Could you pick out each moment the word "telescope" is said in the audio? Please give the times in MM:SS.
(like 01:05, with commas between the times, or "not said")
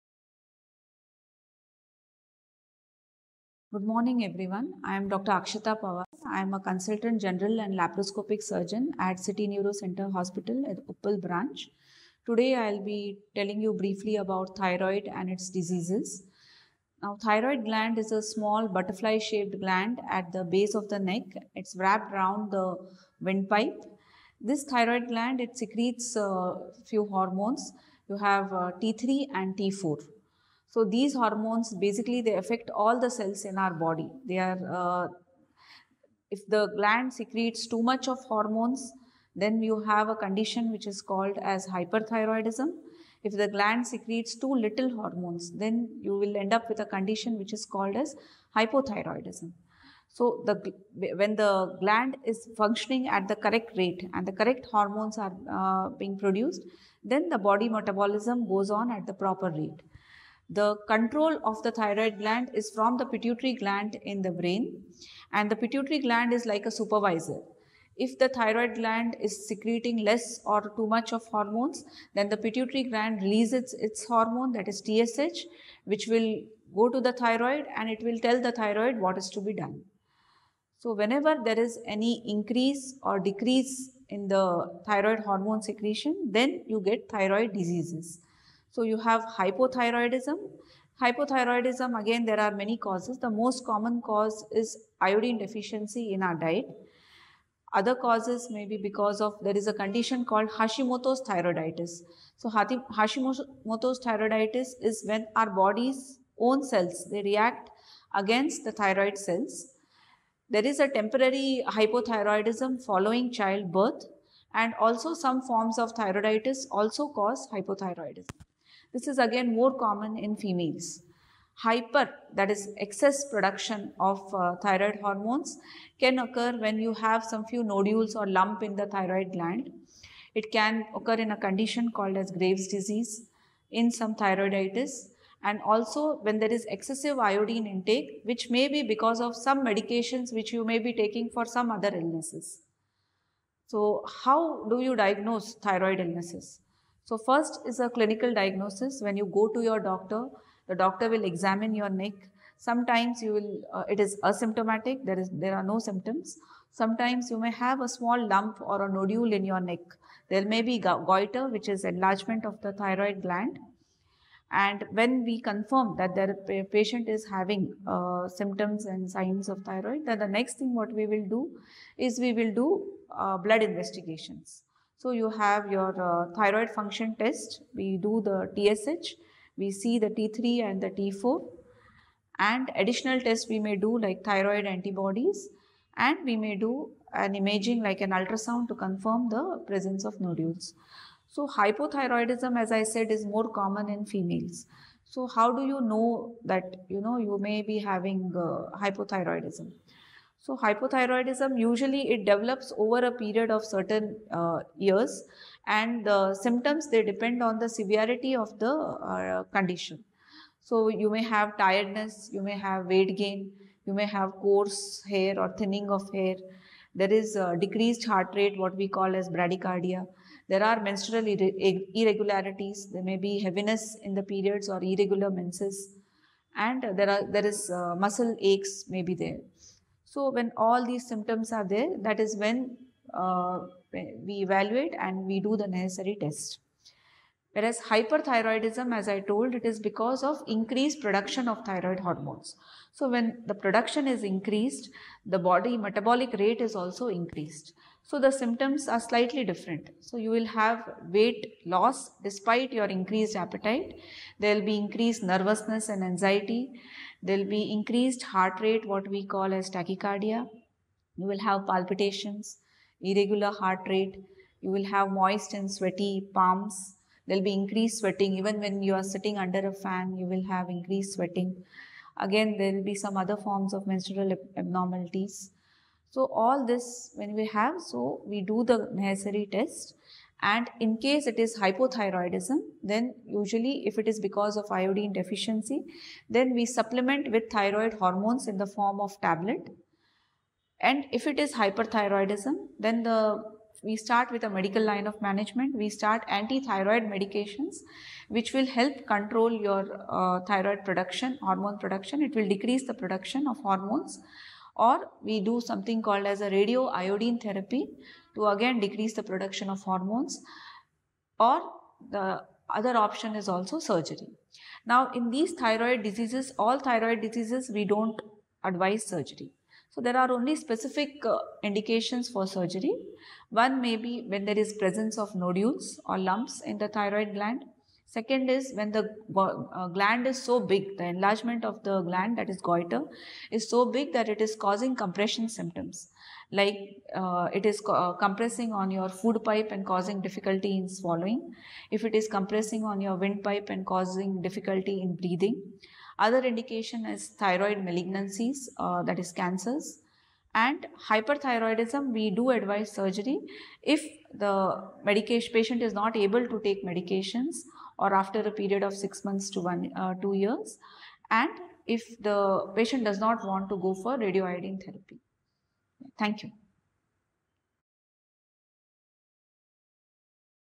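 not said.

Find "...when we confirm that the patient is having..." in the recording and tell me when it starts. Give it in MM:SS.
02:44.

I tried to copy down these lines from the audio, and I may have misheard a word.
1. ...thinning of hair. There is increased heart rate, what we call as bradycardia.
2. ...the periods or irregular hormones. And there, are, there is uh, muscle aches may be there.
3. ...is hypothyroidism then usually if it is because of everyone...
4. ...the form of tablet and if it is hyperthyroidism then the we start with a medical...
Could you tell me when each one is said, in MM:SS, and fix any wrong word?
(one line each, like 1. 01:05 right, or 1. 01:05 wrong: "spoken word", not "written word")
1. 03:35 wrong: "decreased", not "increased"
2. 03:44 wrong: "menses", not "hormones"
3. 04:41 wrong: "iodine", not "everyone"
4. 04:48 right.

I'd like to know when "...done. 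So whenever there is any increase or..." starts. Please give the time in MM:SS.
01:19.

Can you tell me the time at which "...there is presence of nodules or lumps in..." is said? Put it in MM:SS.
05:24.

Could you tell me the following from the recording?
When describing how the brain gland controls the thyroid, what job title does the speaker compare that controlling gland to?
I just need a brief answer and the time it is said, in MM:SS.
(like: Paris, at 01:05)
supervisor, at 01:06.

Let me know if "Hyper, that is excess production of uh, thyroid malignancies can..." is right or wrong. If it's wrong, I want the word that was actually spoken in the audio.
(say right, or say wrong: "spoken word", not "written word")
wrong: "hormones", not "malignancies".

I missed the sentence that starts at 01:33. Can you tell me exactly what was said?
The most common cause is iodine deficiency in our diet.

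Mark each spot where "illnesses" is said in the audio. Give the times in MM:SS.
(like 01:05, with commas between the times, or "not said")
02:21, 02:26.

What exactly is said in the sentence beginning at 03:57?
Whereas hyperthyroidism, as I told, it is because of increased production of thyroid hormones.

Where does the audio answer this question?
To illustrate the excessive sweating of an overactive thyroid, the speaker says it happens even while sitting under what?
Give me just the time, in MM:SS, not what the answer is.
04:29.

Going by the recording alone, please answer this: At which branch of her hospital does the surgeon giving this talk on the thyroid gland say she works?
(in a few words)
Uppal.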